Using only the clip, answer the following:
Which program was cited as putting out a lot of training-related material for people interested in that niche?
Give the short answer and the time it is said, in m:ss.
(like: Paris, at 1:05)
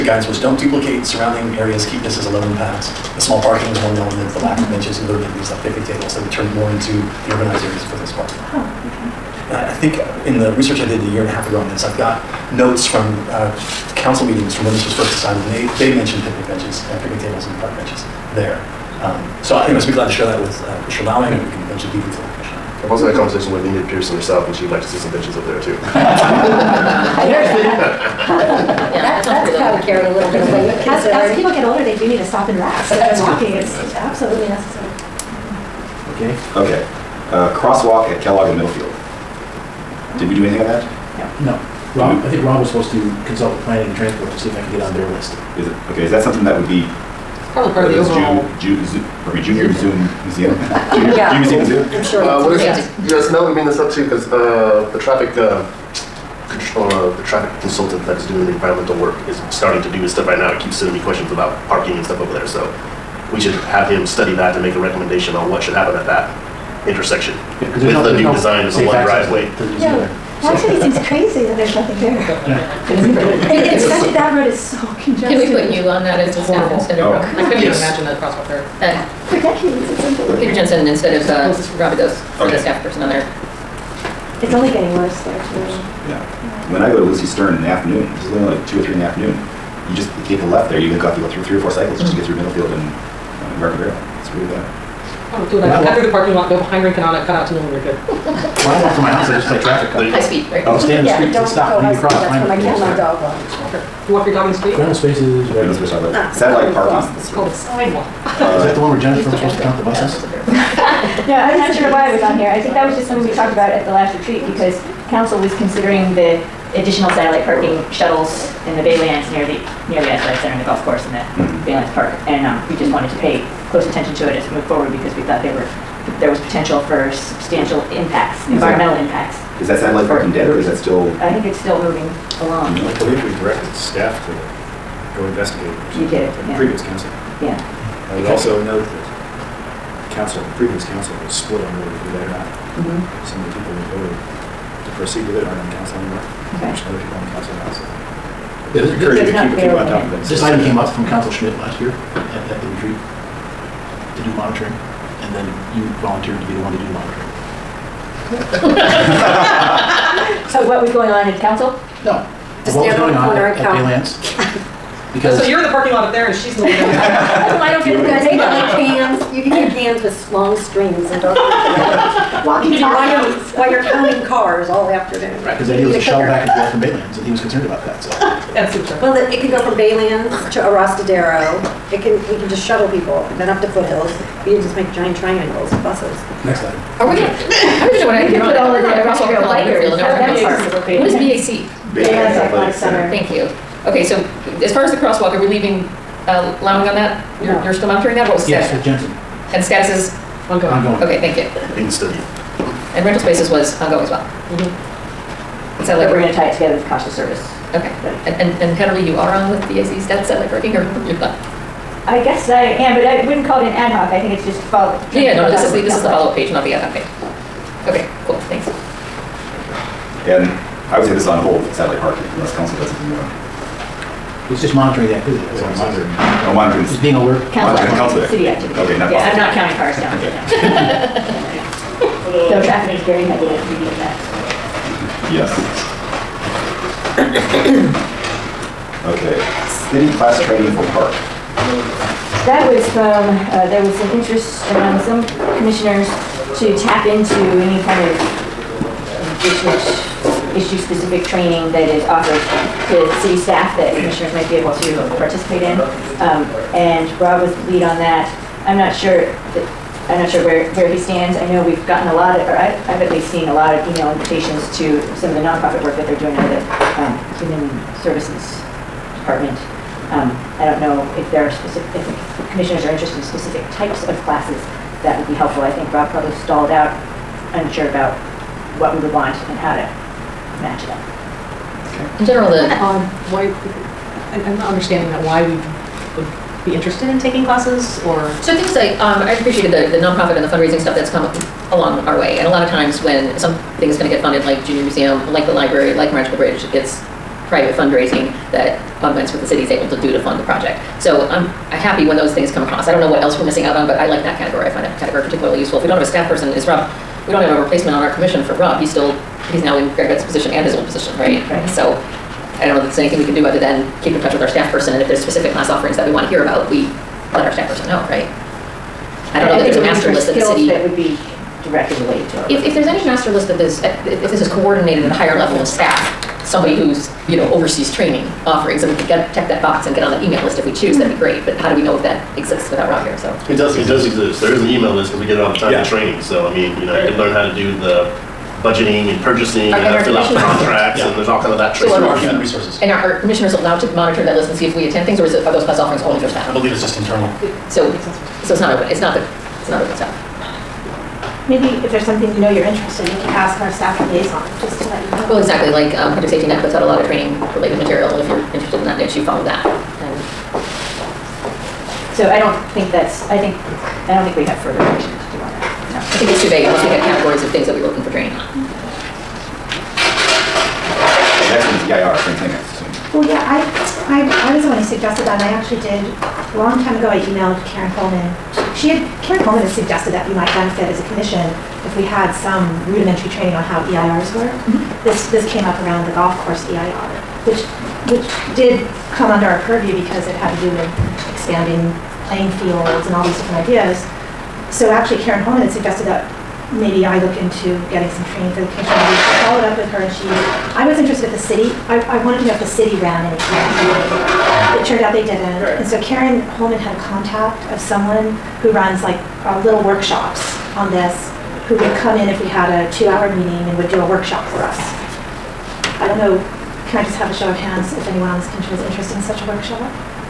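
Project Safety Net, at 5:56.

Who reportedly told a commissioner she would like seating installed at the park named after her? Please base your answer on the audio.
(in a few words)
Enid Pearson.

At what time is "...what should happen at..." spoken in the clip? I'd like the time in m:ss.
1:05.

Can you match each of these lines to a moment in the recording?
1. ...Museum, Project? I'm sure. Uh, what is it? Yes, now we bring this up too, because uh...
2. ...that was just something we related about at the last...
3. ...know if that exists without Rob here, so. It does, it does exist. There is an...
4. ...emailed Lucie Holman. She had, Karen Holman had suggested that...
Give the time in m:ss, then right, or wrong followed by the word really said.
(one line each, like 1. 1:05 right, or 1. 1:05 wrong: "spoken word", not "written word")
1. 0:51 wrong: "Zoo", not "Project"
2. 1:52 wrong: "talked", not "related"
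3. 5:31 right
4. 6:17 wrong: "Karen", not "Lucie".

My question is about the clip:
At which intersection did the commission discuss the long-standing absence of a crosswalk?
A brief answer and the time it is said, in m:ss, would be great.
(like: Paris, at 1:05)
Kellogg and Middlefield, at 0:38.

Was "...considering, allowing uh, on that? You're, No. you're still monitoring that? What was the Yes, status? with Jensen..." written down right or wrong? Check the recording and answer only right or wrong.
wrong.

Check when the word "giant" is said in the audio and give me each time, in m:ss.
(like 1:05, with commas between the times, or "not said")
3:04.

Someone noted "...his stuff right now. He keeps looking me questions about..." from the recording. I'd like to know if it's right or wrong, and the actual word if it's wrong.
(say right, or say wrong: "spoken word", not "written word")
wrong: "sending", not "looking".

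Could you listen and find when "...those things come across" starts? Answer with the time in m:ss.
5:02.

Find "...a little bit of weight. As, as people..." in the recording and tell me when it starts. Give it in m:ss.
0:30.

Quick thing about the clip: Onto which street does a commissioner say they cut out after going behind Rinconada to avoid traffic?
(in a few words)
Newell.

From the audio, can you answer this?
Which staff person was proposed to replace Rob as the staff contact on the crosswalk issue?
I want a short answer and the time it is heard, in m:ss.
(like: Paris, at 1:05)
Peter Jensen, at 1:20.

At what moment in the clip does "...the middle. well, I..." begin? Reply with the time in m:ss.
2:46.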